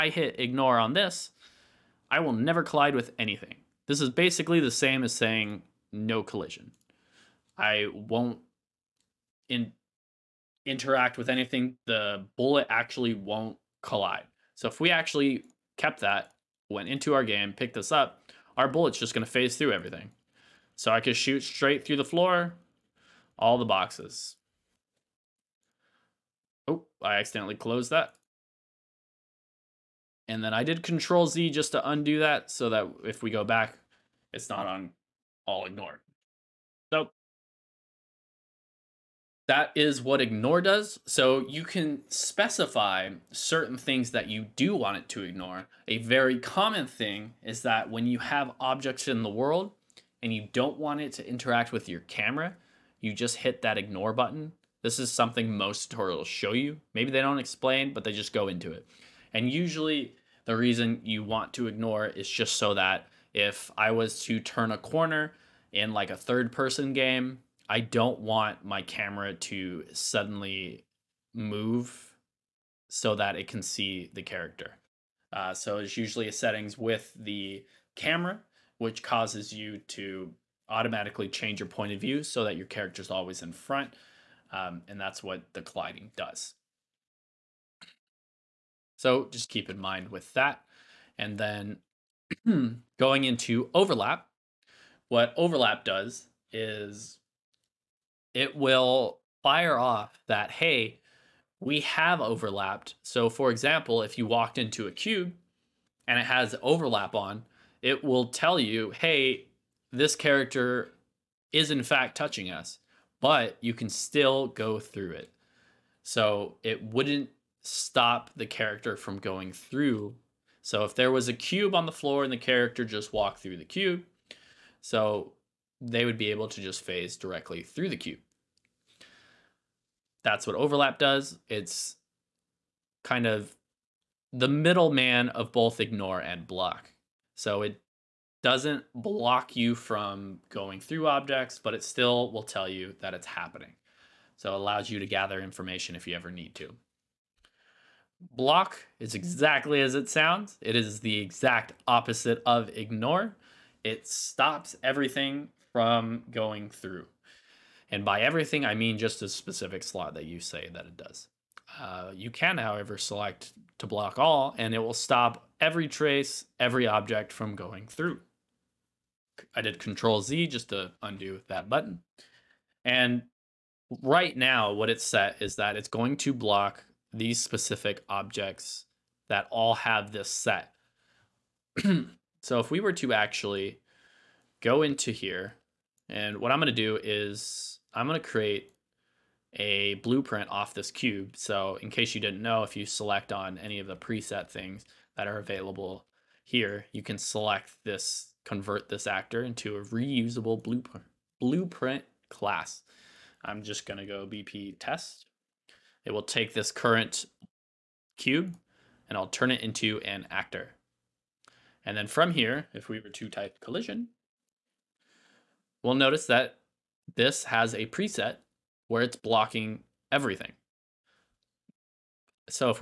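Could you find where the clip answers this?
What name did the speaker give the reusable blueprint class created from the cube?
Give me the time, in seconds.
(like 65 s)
204 s.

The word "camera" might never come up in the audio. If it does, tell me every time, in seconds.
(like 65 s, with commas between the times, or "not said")
52 s, 68 s, 77 s.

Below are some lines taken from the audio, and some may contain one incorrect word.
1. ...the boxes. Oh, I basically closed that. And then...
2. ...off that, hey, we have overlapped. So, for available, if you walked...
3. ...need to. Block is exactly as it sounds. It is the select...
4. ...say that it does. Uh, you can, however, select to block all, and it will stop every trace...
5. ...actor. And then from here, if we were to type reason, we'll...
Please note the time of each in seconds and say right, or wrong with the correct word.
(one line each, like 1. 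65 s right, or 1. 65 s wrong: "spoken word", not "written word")
1. 23 s wrong: "accidentally", not "basically"
2. 99 s wrong: "example", not "available"
3. 146 s wrong: "exact", not "select"
4. 160 s right
5. 210 s wrong: "collision", not "reason".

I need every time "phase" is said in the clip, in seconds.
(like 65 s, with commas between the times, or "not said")
19 s, 126 s.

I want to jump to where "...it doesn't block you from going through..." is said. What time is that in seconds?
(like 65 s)
137 s.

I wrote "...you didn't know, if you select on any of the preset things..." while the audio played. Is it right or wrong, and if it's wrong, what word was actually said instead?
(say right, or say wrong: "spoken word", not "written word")
right.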